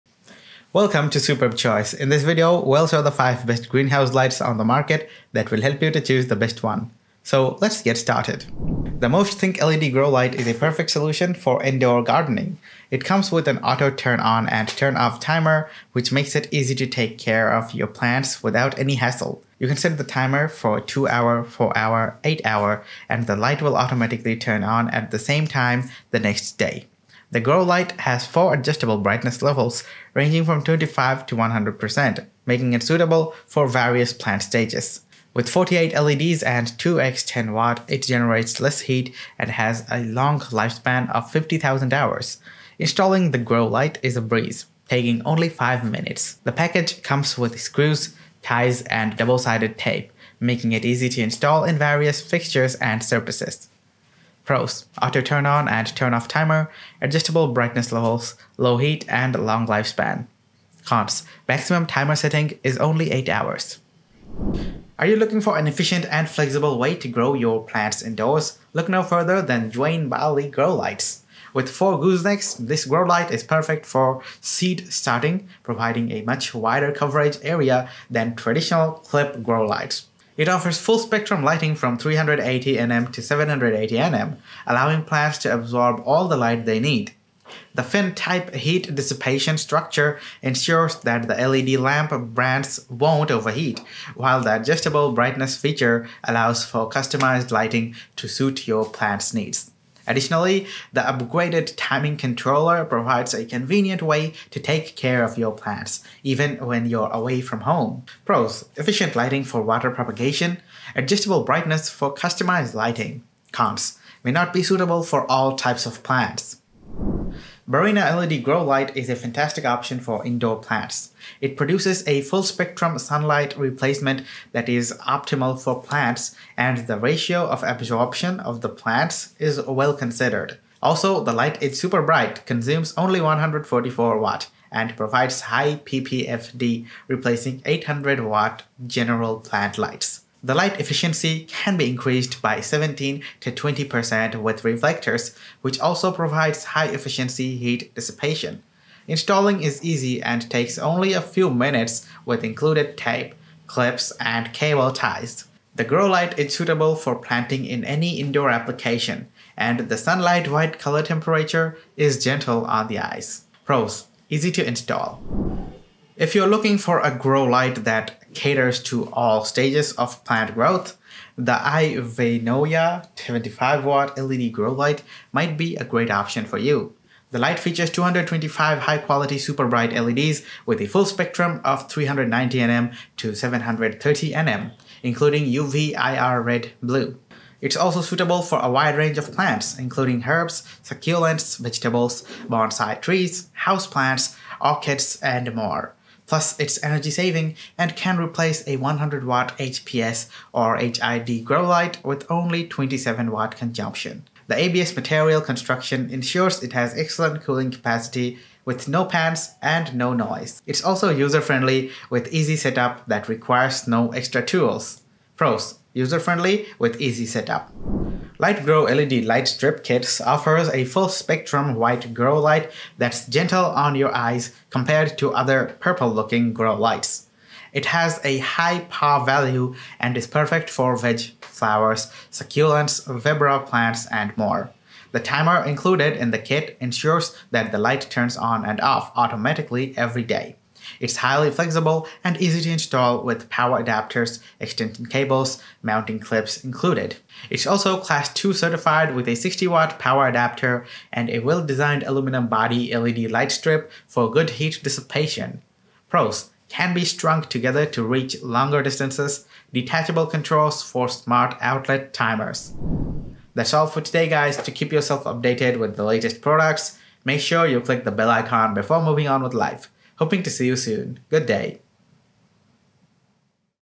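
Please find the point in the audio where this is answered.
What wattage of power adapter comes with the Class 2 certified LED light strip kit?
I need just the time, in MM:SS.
04:09.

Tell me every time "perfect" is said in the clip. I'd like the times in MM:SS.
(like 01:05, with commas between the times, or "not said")
00:10, 01:13, 03:50.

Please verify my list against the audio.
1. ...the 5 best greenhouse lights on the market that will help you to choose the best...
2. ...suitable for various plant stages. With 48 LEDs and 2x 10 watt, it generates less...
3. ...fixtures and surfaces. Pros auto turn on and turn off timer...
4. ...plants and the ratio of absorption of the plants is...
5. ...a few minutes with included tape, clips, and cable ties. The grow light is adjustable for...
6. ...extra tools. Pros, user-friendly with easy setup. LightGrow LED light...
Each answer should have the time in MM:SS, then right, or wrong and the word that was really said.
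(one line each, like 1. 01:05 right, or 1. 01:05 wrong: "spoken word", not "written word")
1. 00:03 right
2. 00:32 right
3. 00:52 right
4. 02:05 right
5. 02:31 wrong: "suitable", not "adjustable"
6. 03:34 right.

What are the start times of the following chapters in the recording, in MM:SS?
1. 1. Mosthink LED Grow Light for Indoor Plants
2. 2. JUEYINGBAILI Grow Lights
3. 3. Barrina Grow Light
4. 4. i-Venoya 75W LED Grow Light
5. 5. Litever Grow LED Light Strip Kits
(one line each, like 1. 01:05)
1. 00:10
2. 01:05
3. 01:57
4. 02:46
5. 03:38.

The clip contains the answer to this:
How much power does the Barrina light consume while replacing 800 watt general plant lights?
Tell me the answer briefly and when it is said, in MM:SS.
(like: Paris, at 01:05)
144 watts, at 02:13.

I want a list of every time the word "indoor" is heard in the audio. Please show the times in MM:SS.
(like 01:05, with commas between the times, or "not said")
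00:11, 01:08, 02:00, 02:38.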